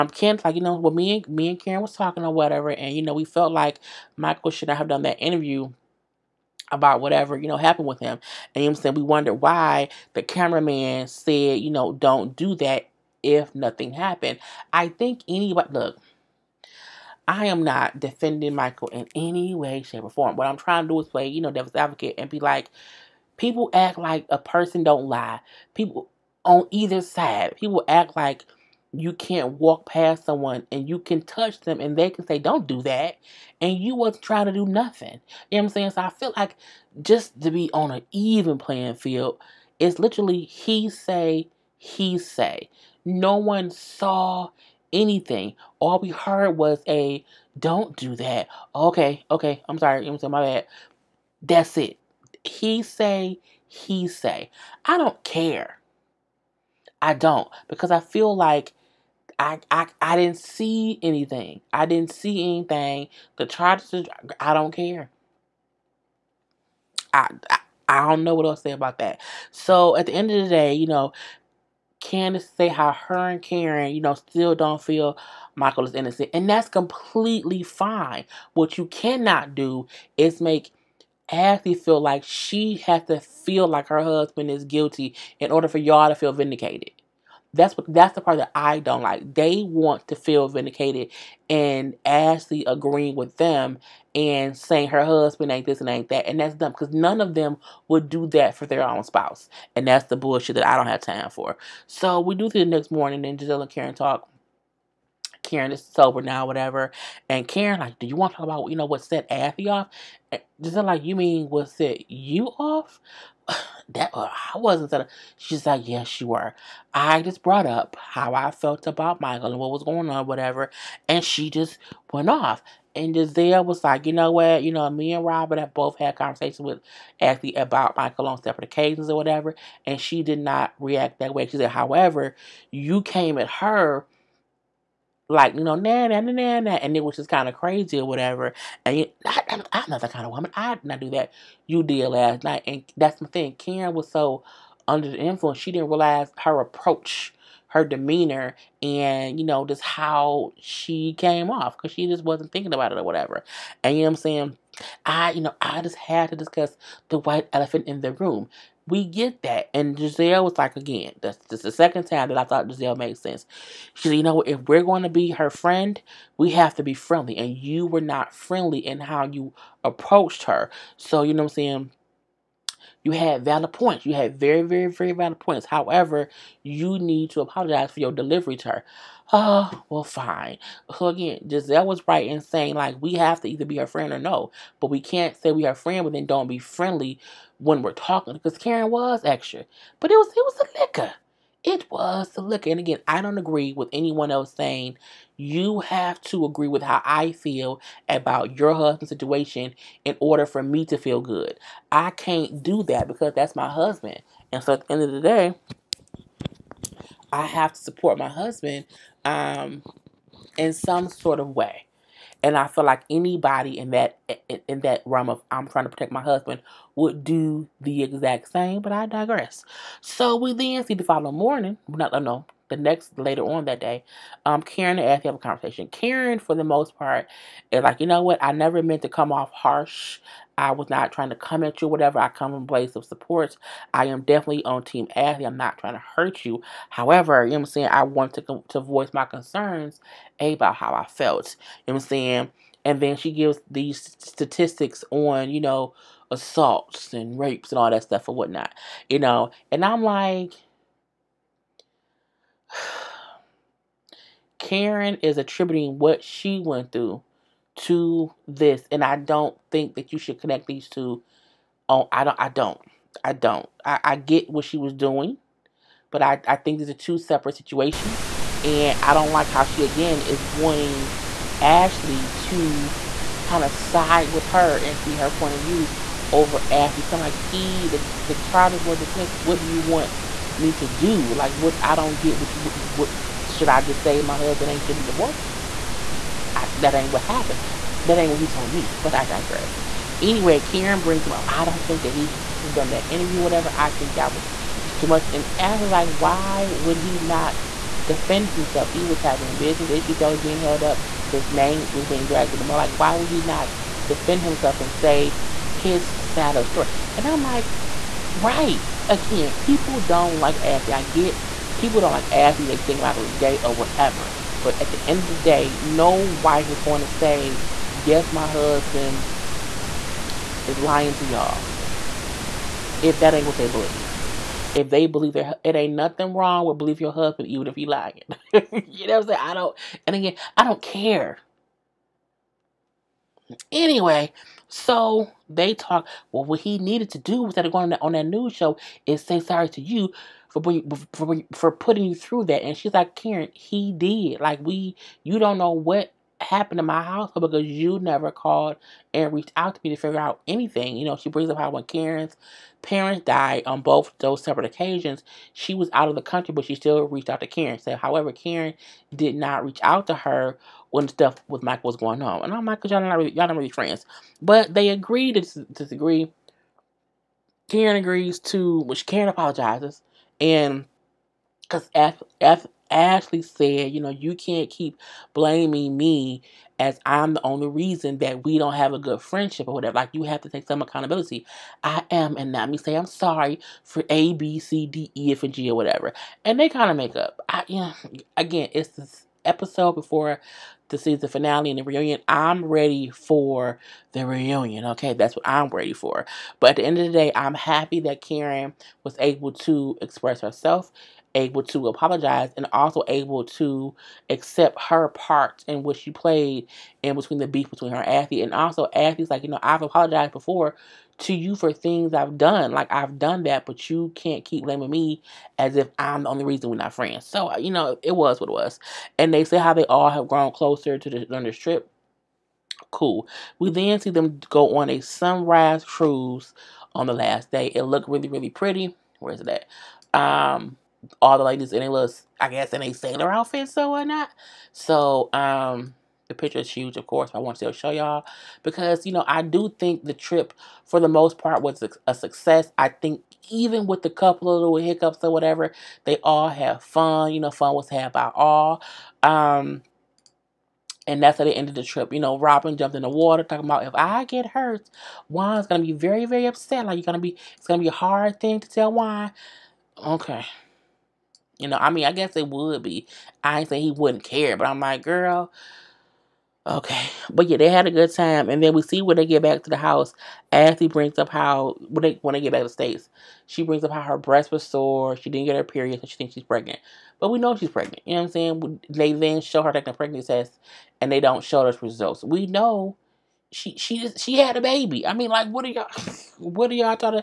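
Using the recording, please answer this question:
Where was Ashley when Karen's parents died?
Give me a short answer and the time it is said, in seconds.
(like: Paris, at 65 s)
out of the country, at 355 s.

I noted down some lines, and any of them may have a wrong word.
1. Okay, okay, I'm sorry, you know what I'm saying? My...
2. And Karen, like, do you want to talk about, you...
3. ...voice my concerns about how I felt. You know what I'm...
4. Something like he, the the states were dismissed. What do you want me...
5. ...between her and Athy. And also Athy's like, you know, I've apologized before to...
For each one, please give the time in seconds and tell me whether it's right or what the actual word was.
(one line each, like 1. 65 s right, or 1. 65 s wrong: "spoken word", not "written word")
1. 48 s right
2. 107 s right
3. 238 s right
4. 277 s wrong: "charges", not "states"
5. 407 s right.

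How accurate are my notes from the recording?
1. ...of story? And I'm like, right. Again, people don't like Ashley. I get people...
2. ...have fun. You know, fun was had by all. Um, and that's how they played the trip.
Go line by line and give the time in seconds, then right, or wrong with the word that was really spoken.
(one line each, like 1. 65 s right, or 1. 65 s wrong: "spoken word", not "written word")
1. 306 s right
2. 446 s wrong: "ended", not "played".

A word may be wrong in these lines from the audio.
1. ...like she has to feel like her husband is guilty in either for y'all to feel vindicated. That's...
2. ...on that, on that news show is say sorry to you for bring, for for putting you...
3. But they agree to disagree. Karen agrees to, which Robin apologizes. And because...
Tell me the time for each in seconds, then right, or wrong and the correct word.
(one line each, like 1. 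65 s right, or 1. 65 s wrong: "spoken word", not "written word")
1. 81 s wrong: "order", not "either"
2. 337 s right
3. 364 s wrong: "Karen", not "Robin".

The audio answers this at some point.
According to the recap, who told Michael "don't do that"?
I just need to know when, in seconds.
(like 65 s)
10 s.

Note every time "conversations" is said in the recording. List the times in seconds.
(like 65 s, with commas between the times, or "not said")
126 s, 225 s.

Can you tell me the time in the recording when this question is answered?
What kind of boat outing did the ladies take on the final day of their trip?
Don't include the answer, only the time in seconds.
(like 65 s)
424 s.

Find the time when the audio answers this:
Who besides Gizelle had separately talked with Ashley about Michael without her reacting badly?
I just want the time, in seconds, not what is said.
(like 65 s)
125 s.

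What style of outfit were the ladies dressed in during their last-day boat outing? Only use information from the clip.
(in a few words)
sailor outfit.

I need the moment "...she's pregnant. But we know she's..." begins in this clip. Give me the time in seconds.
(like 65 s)
476 s.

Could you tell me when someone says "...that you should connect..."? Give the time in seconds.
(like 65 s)
259 s.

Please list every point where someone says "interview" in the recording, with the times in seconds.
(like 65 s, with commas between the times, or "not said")
5 s, 293 s.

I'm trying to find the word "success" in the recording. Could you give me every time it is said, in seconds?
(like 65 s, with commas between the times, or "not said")
442 s.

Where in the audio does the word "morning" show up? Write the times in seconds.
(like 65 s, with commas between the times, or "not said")
102 s, 221 s.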